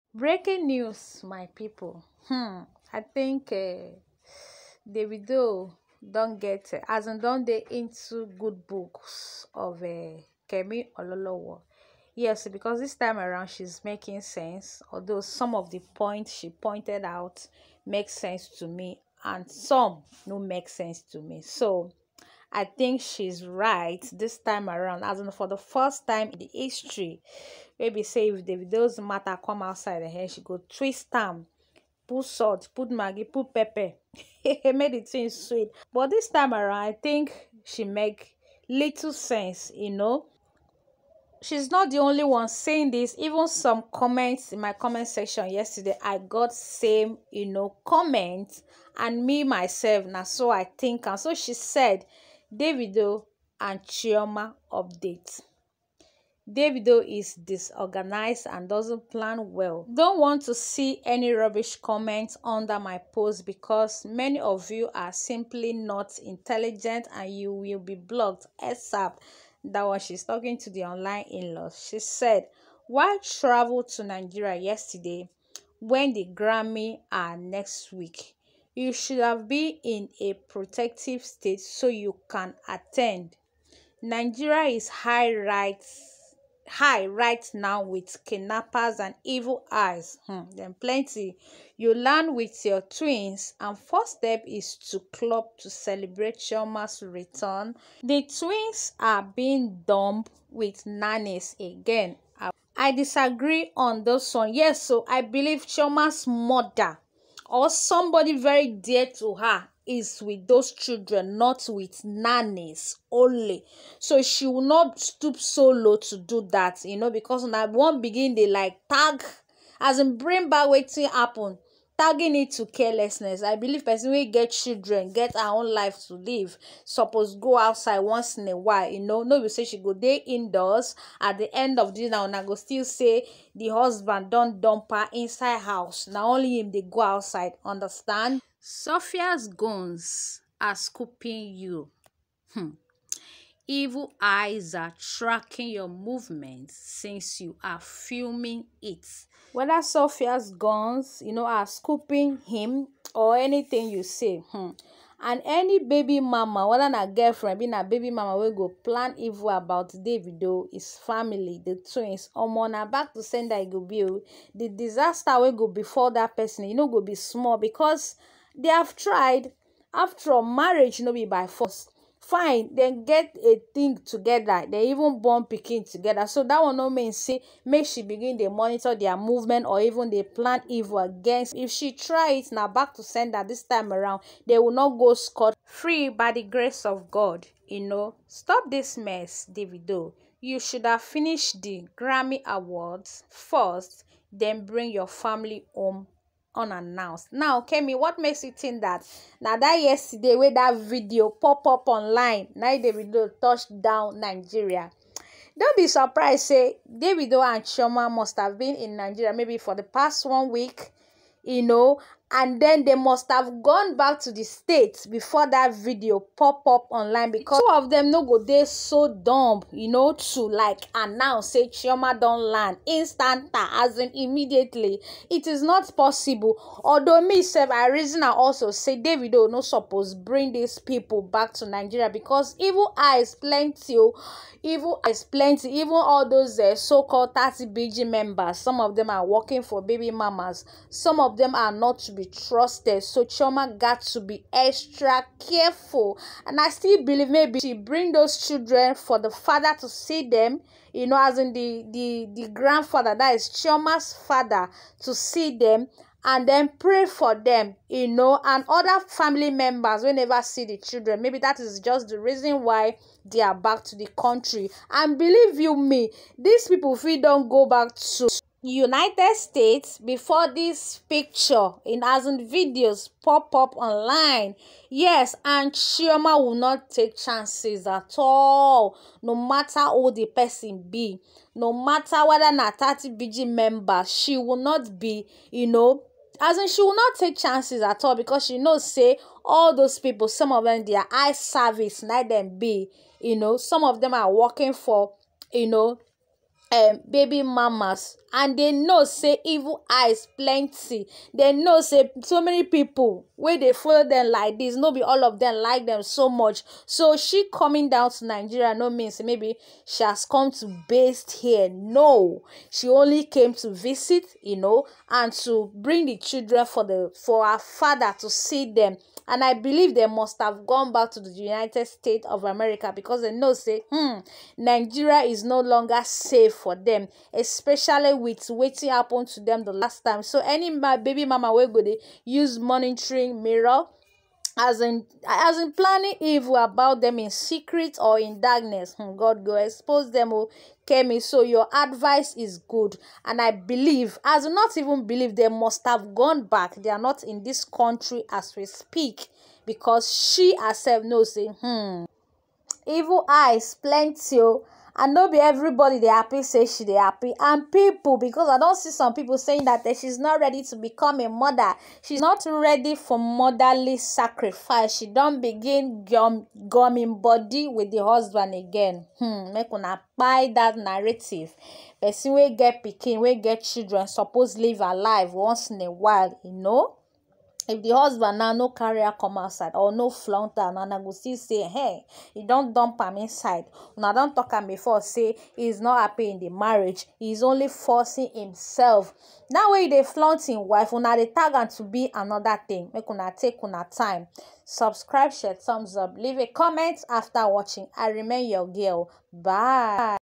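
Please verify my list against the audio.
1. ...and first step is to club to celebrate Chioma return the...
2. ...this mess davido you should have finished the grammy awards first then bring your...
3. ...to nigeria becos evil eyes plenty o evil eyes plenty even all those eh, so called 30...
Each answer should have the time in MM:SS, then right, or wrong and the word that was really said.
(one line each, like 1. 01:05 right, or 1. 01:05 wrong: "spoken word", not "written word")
1. 01:33 right
2. 03:08 right
3. 03:51 right.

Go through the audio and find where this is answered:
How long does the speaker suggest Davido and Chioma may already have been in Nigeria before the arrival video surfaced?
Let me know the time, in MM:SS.
03:30.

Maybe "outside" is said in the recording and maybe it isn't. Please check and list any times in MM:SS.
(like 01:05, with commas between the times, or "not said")
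00:29, 02:07, 02:17, 06:19.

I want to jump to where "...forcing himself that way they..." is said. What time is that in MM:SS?
06:27.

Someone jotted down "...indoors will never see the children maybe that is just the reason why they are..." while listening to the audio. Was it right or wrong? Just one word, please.
wrong.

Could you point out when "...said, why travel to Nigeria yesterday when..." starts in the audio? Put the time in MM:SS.
01:11.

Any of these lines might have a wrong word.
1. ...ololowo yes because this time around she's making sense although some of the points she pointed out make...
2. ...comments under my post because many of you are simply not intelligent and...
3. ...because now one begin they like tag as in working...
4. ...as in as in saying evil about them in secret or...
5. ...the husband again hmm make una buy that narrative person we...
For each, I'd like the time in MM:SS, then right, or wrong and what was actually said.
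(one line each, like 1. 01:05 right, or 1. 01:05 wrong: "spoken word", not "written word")
1. 00:10 right
2. 01:01 right
3. 01:57 wrong: "bring", not "working"
4. 05:34 wrong: "planning", not "saying"
5. 06:07 right.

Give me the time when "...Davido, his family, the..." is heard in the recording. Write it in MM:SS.
02:39.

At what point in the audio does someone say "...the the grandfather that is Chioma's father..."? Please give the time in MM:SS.
04:11.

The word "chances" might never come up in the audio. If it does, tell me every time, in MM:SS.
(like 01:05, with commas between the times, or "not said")
04:37, 04:47.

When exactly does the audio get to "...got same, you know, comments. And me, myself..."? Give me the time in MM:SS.
00:46.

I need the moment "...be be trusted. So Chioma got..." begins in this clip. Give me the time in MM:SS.
04:02.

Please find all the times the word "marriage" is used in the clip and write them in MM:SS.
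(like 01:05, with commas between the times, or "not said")
02:50, 06:26.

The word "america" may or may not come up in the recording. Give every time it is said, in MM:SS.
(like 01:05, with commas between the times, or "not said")
05:22.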